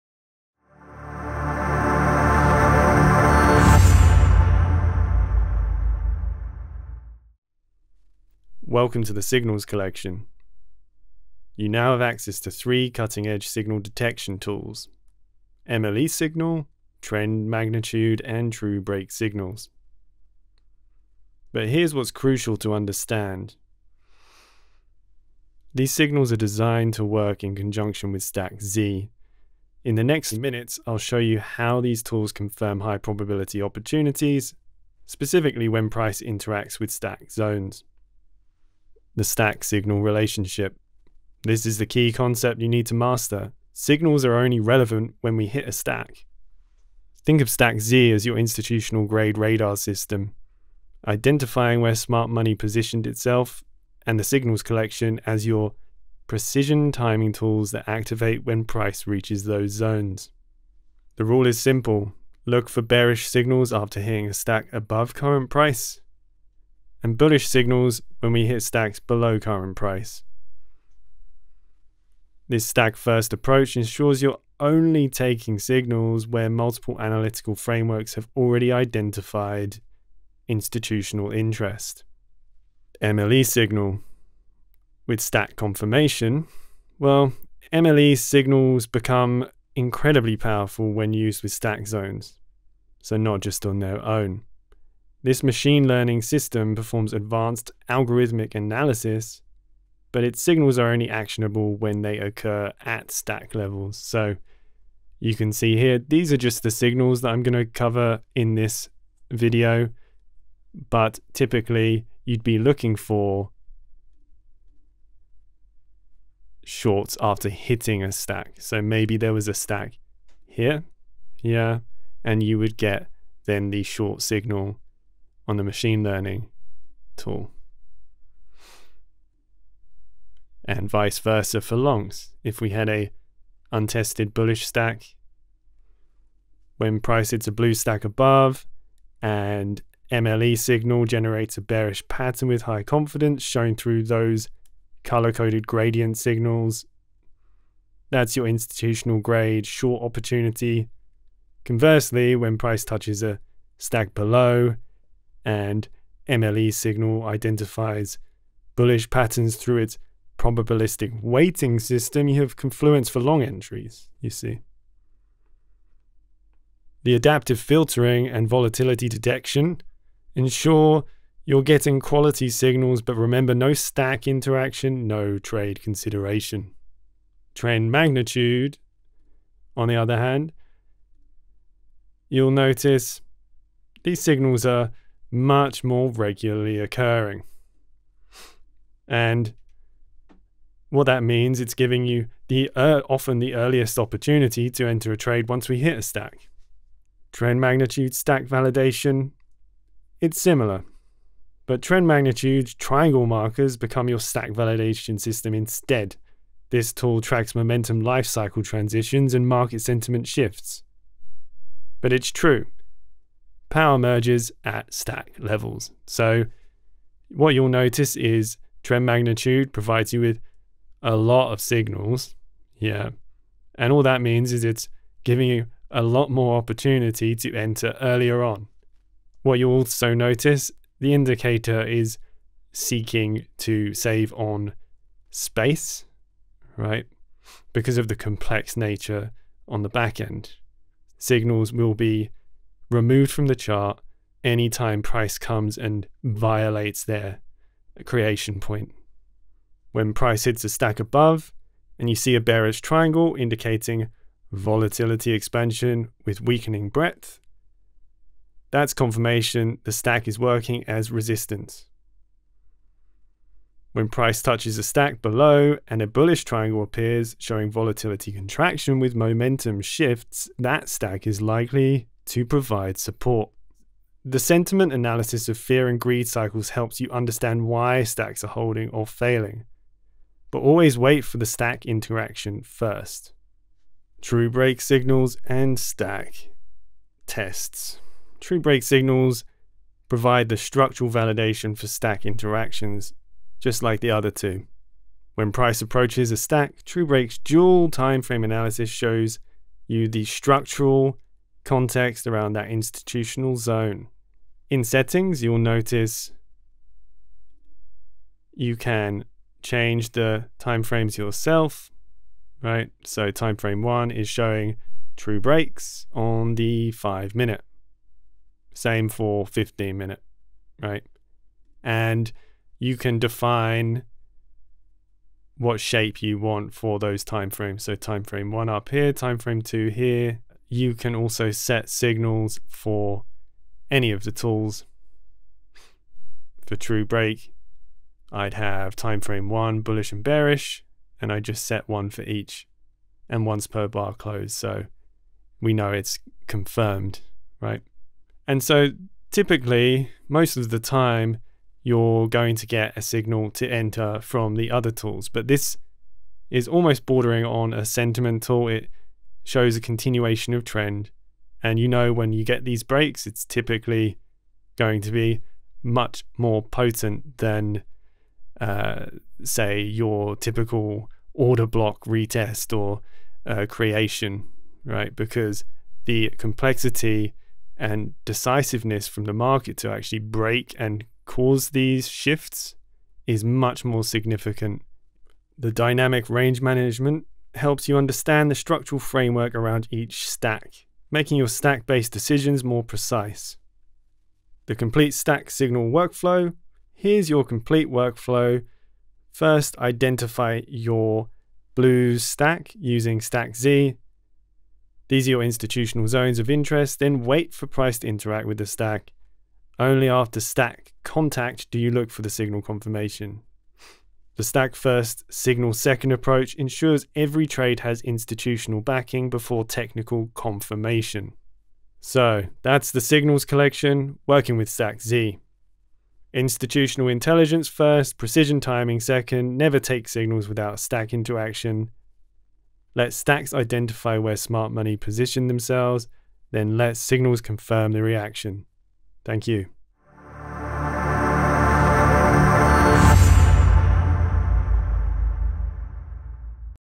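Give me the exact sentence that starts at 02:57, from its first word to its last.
Trend magnitude, on the other hand, you'll notice these signals are much more regularly occurring.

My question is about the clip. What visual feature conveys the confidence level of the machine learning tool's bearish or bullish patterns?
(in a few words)
color coded gradient signals.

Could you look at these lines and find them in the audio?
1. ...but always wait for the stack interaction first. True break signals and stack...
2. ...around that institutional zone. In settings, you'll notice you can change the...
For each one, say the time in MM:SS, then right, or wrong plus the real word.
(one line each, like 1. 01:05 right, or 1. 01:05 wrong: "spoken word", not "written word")
1. 04:40 right
2. 05:02 right.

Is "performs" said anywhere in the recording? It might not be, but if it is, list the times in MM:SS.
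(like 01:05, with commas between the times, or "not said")
01:36.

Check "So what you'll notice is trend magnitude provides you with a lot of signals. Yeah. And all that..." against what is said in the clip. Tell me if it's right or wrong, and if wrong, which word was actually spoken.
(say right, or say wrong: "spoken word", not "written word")
right.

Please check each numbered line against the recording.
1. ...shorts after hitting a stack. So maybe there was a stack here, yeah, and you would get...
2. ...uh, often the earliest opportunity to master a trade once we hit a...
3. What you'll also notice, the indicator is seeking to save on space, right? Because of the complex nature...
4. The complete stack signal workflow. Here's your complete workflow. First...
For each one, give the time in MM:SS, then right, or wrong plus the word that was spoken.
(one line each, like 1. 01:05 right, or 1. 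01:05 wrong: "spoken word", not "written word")
1. 01:56 right
2. 03:12 wrong: "enter", not "master"
3. 03:49 right
4. 06:34 right.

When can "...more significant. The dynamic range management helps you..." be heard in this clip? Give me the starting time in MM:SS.
06:23.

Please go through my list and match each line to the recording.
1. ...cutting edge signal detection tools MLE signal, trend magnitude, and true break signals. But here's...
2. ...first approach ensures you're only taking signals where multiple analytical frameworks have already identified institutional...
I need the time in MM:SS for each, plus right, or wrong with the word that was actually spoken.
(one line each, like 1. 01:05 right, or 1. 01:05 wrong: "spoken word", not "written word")
1. 00:12 right
2. 01:12 right.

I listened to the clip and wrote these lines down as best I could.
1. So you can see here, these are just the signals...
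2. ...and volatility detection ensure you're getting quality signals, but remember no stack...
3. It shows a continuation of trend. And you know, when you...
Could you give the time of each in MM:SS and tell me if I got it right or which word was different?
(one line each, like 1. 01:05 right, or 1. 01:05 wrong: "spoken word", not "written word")
1. 01:43 right
2. 02:48 right
3. 05:58 right.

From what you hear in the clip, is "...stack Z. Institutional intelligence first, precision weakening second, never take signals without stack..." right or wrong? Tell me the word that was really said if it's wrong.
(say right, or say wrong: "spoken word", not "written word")
wrong: "timing", not "weakening".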